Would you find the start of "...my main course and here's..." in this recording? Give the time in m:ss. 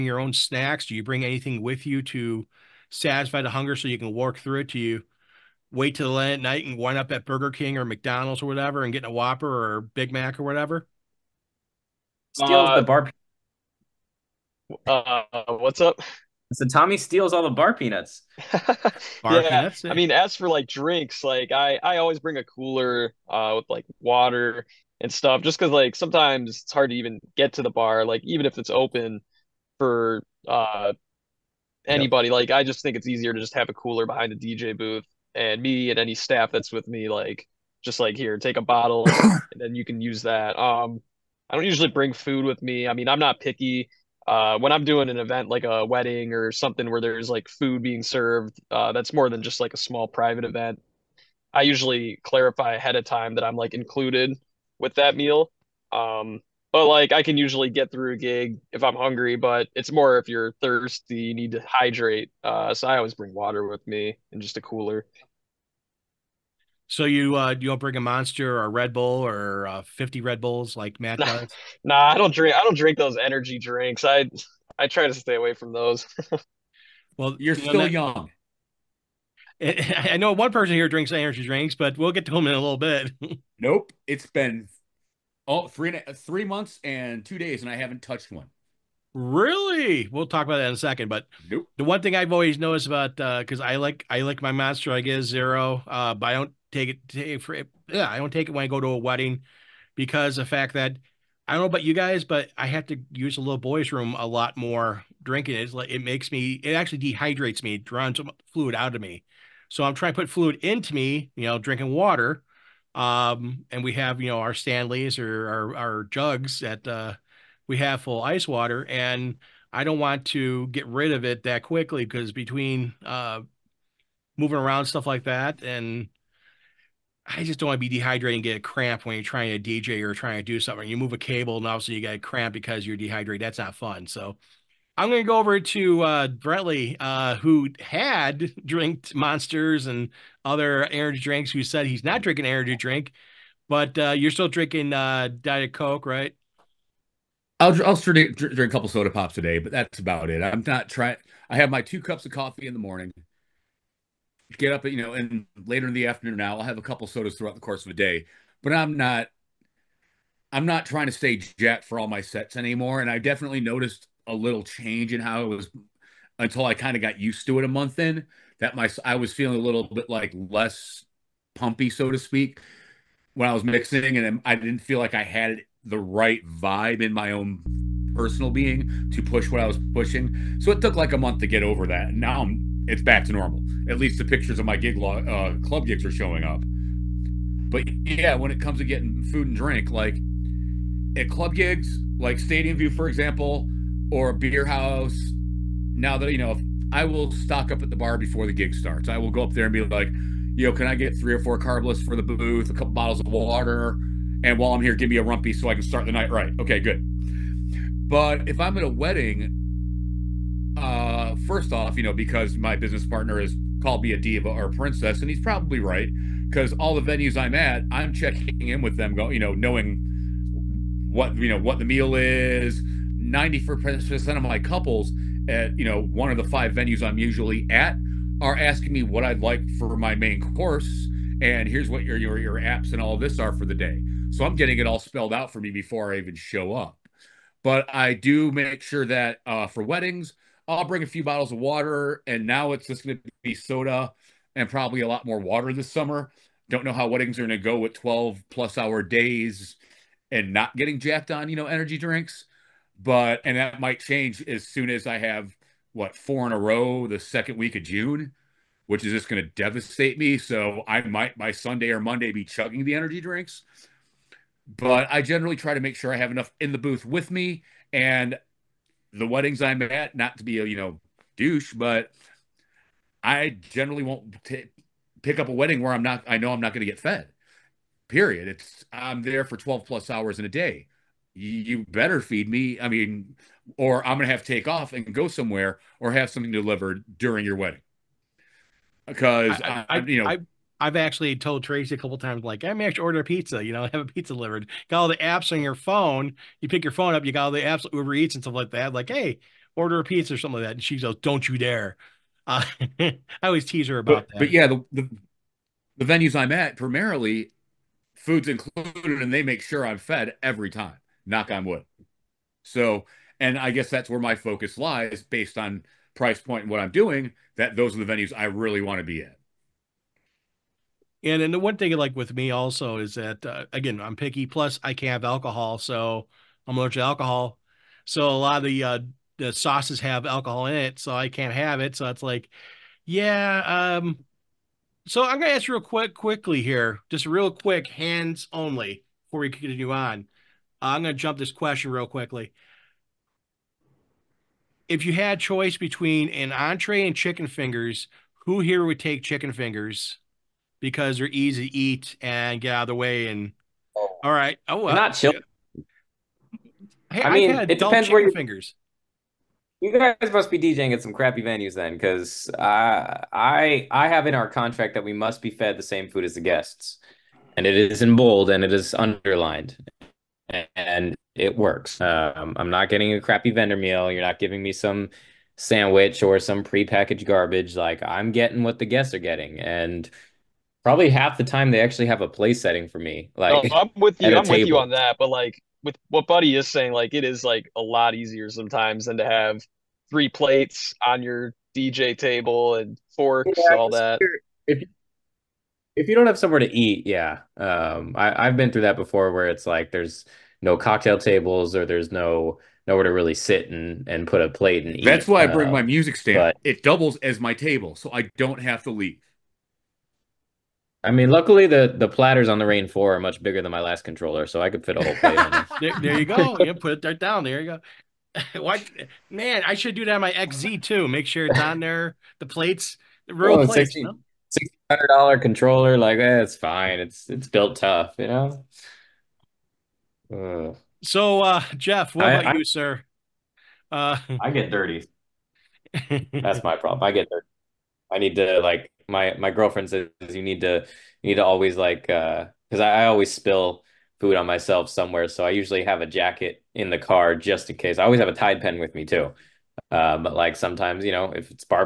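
3:49.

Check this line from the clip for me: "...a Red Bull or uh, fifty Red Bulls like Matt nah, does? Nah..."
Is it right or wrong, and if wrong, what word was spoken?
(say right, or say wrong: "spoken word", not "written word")
right.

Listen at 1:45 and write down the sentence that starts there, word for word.
is like it makes me it actually dehydrates me, it drowns fluid out of me.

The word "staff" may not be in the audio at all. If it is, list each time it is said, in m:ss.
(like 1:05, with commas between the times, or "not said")
0:36.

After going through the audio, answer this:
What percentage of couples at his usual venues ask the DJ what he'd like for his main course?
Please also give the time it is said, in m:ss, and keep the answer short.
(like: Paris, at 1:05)
94%, at 3:43.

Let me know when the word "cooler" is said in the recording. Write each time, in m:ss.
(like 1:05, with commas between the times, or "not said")
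0:22, 0:33, 1:04.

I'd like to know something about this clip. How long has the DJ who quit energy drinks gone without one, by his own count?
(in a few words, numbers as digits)
3 months and 2 days.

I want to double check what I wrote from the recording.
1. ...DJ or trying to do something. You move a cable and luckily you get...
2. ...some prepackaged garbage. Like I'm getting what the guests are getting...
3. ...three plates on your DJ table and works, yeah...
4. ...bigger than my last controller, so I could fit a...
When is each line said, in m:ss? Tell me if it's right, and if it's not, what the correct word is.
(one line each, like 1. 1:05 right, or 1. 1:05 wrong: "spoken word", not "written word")
1. 2:09 wrong: "obviously", not "luckily"
2. 6:16 right
3. 6:30 wrong: "forks", not "works"
4. 6:53 right.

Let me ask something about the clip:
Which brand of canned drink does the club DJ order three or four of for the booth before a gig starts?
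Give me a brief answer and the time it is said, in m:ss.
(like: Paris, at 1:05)
Carbliss, at 3:21.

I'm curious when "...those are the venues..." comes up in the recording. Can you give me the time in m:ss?
5:17.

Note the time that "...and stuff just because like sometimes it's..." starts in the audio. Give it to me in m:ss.
0:25.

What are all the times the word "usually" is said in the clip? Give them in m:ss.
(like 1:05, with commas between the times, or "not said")
0:41, 0:51, 0:57, 3:47, 7:25.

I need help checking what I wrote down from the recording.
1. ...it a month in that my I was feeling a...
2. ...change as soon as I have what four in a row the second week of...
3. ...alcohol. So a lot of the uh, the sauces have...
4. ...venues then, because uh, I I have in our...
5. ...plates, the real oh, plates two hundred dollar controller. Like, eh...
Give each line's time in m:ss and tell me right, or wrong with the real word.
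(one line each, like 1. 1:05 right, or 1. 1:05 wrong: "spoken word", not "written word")
1. 2:47 right
2. 4:13 right
3. 5:27 right
4. 6:01 right
5. 7:02 wrong: "six", not "two".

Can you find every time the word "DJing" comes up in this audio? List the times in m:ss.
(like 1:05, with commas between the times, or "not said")
6:00.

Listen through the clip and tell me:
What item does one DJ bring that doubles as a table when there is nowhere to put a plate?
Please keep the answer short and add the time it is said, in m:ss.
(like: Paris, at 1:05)
Music stand, at 6:45.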